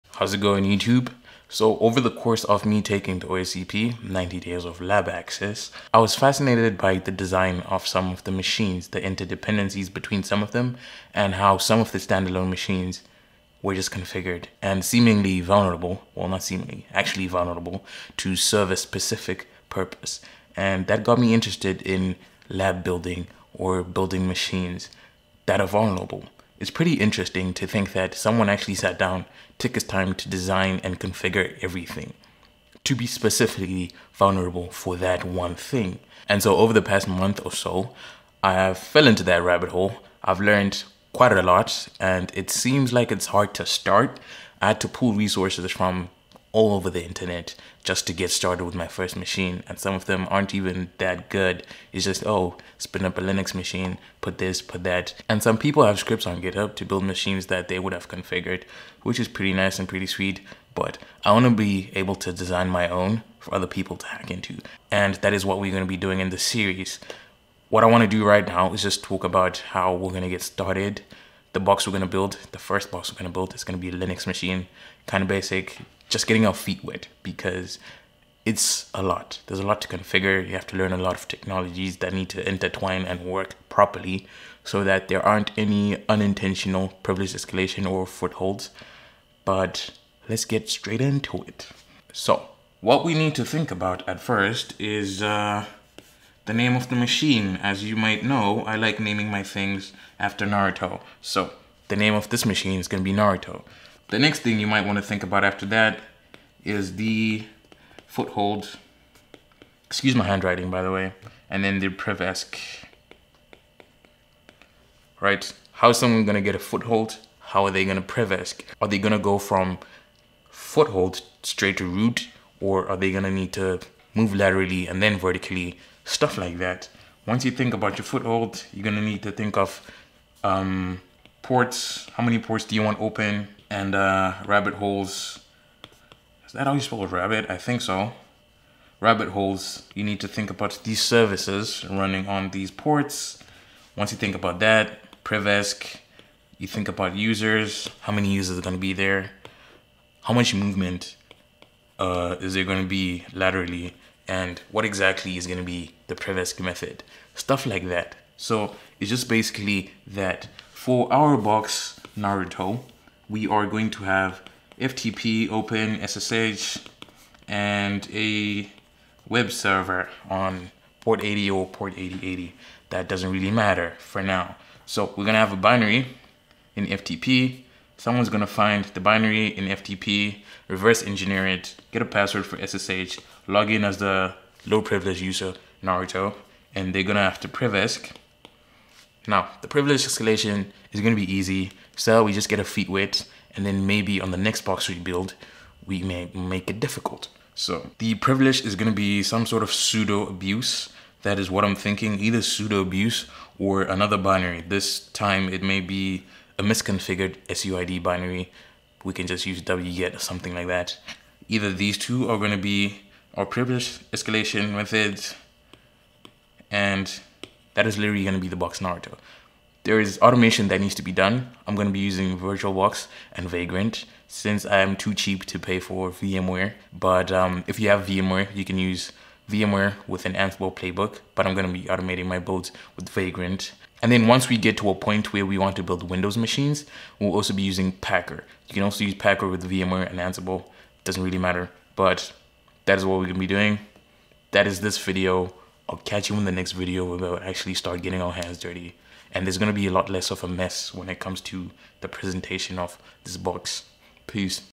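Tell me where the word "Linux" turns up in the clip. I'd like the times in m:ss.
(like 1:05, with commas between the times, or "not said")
0:53, 1:14.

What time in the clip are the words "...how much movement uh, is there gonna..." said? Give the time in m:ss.
2:30.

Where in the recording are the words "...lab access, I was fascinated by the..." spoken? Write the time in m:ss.
0:04.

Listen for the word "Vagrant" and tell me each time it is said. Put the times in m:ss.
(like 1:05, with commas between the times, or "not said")
3:43, 3:53.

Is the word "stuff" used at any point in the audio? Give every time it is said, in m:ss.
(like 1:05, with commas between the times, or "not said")
2:06, 2:37.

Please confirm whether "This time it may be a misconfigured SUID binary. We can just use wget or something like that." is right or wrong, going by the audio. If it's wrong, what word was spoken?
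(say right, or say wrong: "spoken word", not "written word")
right.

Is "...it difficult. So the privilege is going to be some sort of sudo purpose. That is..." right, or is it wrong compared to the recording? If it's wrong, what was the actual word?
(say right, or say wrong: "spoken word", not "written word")
wrong: "abuse", not "purpose".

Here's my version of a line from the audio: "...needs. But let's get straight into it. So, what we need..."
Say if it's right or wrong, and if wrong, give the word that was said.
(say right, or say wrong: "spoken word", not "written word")
wrong: "footholds", not "needs".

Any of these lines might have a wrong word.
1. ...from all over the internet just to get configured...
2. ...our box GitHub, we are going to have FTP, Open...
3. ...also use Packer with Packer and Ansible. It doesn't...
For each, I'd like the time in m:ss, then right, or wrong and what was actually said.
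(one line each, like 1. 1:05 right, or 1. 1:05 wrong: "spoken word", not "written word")
1. 0:45 wrong: "started", not "configured"
2. 2:41 wrong: "Naruto", not "GitHub"
3. 3:58 wrong: "VMware", not "Packer".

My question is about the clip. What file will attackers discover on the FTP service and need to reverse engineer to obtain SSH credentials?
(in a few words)
A binary.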